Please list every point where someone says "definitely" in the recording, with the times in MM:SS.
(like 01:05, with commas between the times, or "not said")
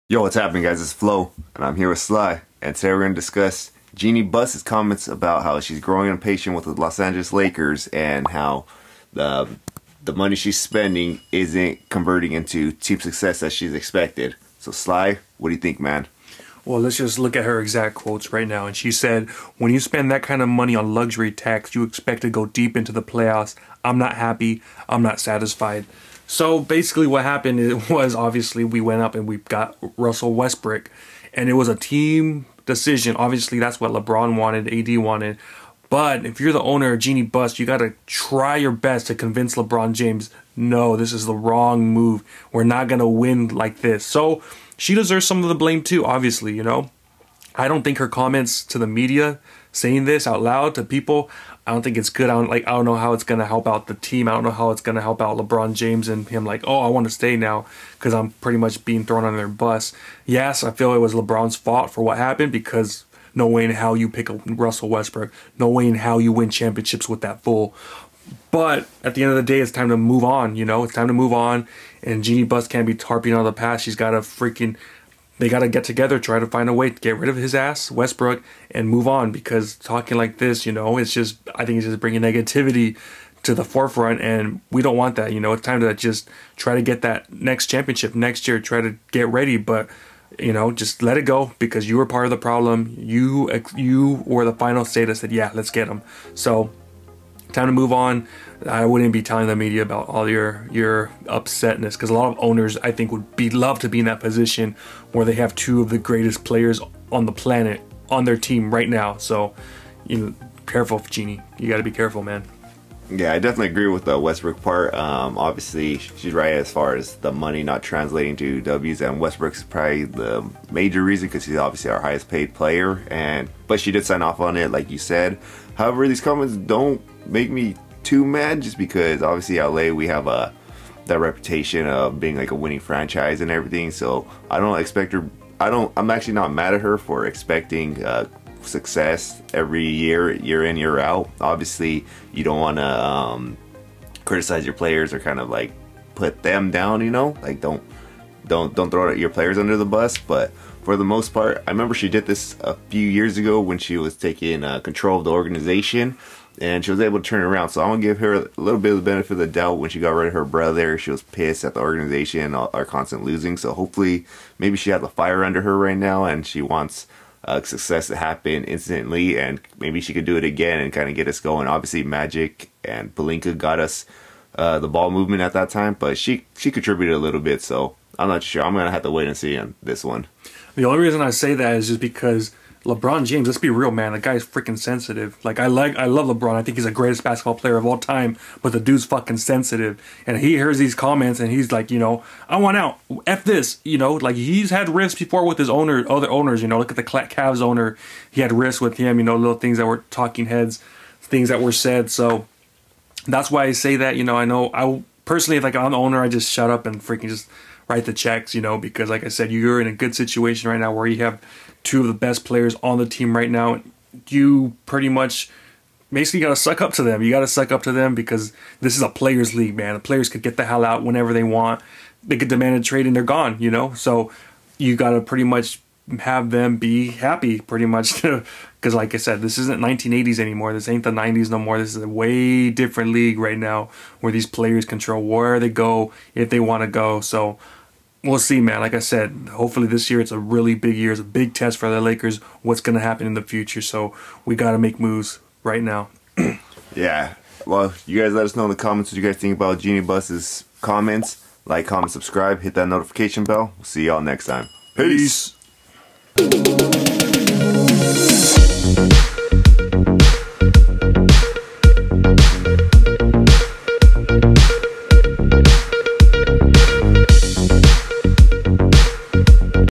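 01:53.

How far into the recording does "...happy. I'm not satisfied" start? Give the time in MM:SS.
00:24.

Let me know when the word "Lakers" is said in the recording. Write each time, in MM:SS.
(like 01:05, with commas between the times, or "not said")
00:07, 04:02.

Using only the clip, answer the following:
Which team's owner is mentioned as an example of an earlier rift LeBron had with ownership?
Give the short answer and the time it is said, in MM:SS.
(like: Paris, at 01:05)
The Cavs, at 03:17.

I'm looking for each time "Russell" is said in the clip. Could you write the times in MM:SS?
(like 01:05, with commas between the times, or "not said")
00:29, 01:04.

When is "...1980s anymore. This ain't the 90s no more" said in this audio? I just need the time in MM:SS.
03:49.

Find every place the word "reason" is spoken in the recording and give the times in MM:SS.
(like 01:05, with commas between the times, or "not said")
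02:01, 03:00.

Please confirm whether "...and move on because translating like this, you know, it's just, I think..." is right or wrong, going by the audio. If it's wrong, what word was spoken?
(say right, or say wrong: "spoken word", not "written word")
wrong: "talking", not "translating".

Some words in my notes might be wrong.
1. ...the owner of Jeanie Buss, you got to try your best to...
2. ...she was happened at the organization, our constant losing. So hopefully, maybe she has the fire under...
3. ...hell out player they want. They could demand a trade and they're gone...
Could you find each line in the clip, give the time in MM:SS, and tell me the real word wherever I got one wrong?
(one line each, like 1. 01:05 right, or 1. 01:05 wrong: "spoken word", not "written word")
1. 00:36 right
2. 02:40 wrong: "pissed", not "happened"
3. 03:40 wrong: "whenever", not "player".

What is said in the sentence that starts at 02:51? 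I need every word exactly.
Obviously, Magic and Pelinka got us uh, the ball movement at that time, but she she contributed a little bit.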